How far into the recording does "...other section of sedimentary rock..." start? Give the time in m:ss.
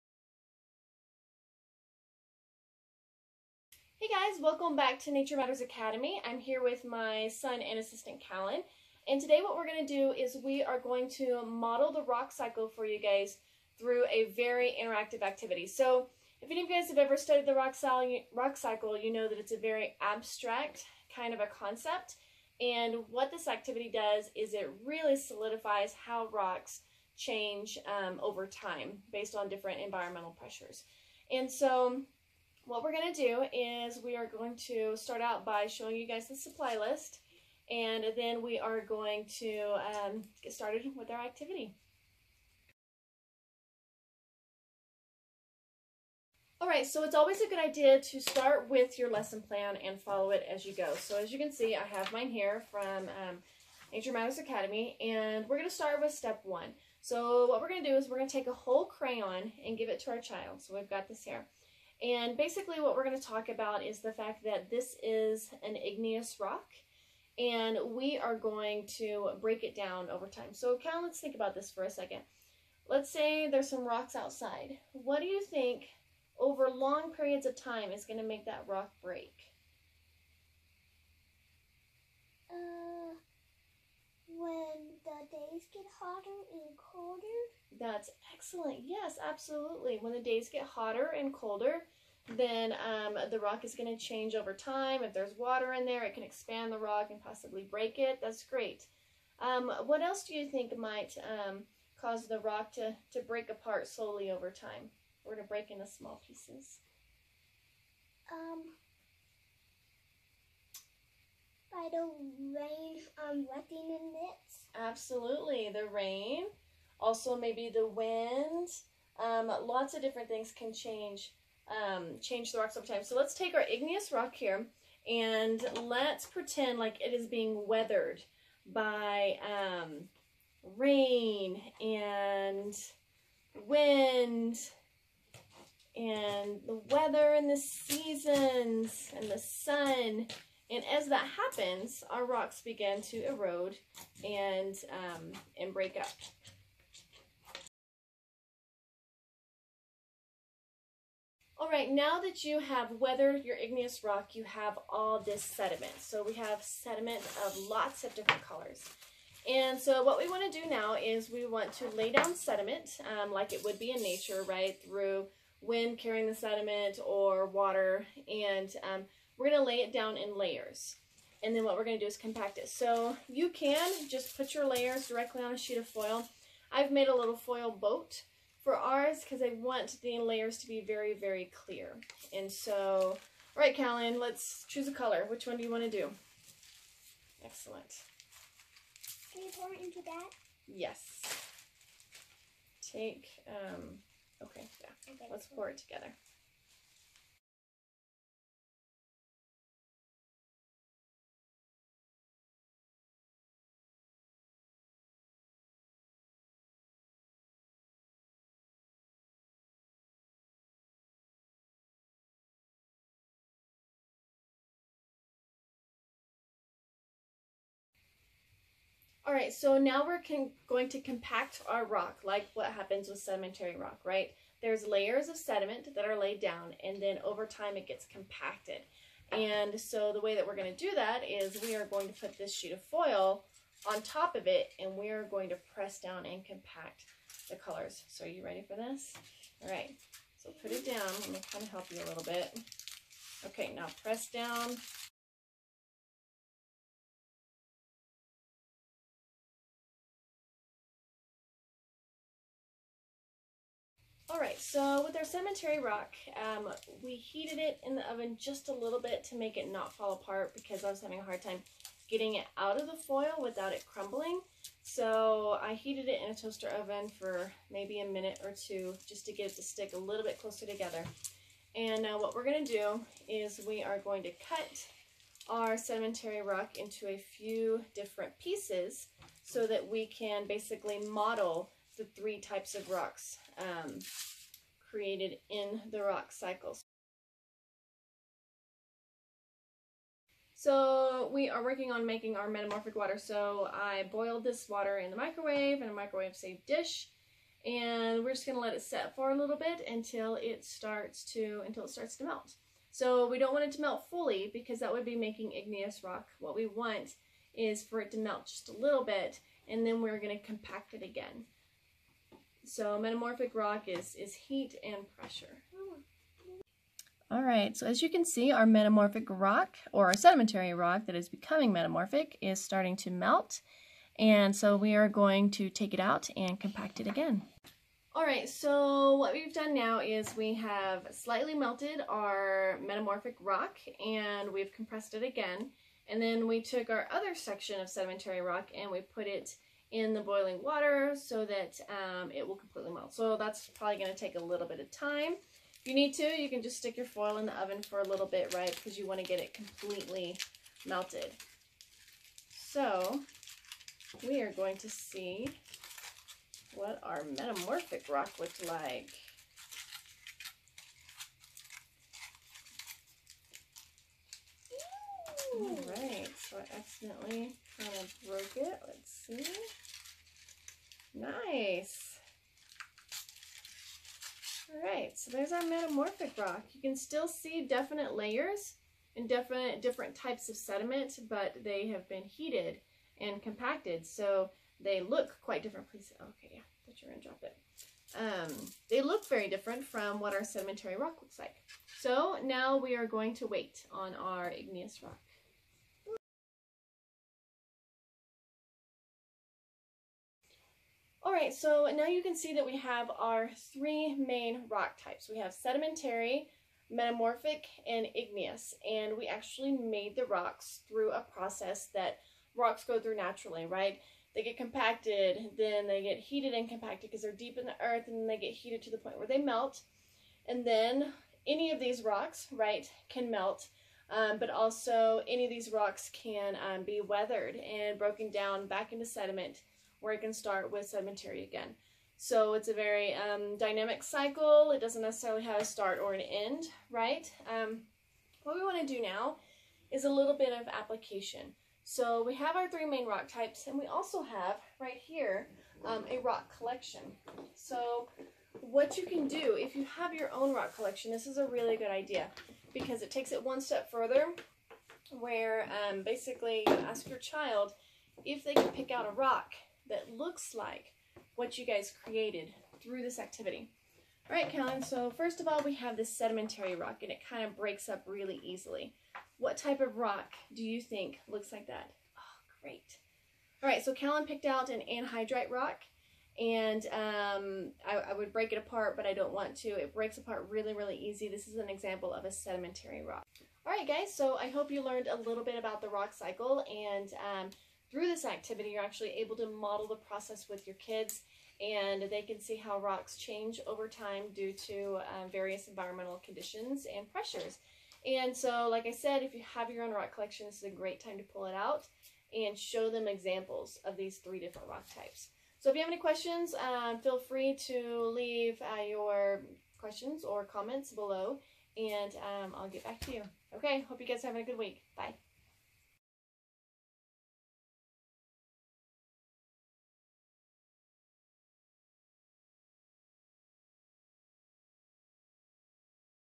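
5:37.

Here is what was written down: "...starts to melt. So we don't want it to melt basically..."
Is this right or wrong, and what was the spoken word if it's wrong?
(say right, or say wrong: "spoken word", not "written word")
wrong: "fully", not "basically".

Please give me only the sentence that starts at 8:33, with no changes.
Okay, hope you guys are having a good week.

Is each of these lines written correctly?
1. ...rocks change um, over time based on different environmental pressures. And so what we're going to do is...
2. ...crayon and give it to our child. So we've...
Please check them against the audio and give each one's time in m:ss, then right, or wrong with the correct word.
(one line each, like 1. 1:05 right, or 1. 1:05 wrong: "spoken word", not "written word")
1. 0:26 right
2. 0:58 right.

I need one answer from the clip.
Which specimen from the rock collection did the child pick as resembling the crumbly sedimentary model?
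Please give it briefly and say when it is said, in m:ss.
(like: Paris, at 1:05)
anhydrite, at 7:54.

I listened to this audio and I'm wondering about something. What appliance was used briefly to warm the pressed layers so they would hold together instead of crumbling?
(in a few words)
toaster oven.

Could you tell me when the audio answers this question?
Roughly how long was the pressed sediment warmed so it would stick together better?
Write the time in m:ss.
4:27.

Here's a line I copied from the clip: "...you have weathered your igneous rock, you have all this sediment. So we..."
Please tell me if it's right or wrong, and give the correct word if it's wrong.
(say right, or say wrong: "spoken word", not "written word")
right.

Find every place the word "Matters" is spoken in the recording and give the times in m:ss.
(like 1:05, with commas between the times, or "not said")
0:05, 0:54.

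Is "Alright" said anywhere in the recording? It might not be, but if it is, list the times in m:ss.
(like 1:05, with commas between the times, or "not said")
0:46, 4:14.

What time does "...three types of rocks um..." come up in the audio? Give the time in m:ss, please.
4:42.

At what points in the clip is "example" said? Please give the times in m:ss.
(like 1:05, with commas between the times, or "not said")
8:01, 8:23.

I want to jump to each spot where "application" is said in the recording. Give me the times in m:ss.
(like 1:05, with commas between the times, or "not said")
7:20.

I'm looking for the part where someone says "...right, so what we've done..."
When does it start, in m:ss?
5:28.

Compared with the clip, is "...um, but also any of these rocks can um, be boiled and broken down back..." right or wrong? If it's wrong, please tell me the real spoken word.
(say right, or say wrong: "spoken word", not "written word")
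wrong: "weathered", not "boiled".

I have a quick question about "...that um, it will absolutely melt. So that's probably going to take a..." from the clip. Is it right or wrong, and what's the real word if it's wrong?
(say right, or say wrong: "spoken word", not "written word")
wrong: "completely", not "absolutely".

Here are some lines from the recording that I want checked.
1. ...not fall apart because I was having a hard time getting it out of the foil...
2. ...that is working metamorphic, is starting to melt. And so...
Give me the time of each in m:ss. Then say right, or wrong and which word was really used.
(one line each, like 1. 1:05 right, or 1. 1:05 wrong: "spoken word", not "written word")
1. 4:19 right
2. 5:21 wrong: "becoming", not "working".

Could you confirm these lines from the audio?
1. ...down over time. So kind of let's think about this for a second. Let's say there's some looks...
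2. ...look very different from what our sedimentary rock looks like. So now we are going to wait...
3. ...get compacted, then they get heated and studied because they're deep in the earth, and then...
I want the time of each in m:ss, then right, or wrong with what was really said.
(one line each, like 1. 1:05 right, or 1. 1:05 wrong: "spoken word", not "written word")
1. 1:09 wrong: "rocks", not "looks"
2. 6:29 right
3. 6:54 wrong: "compacted", not "studied".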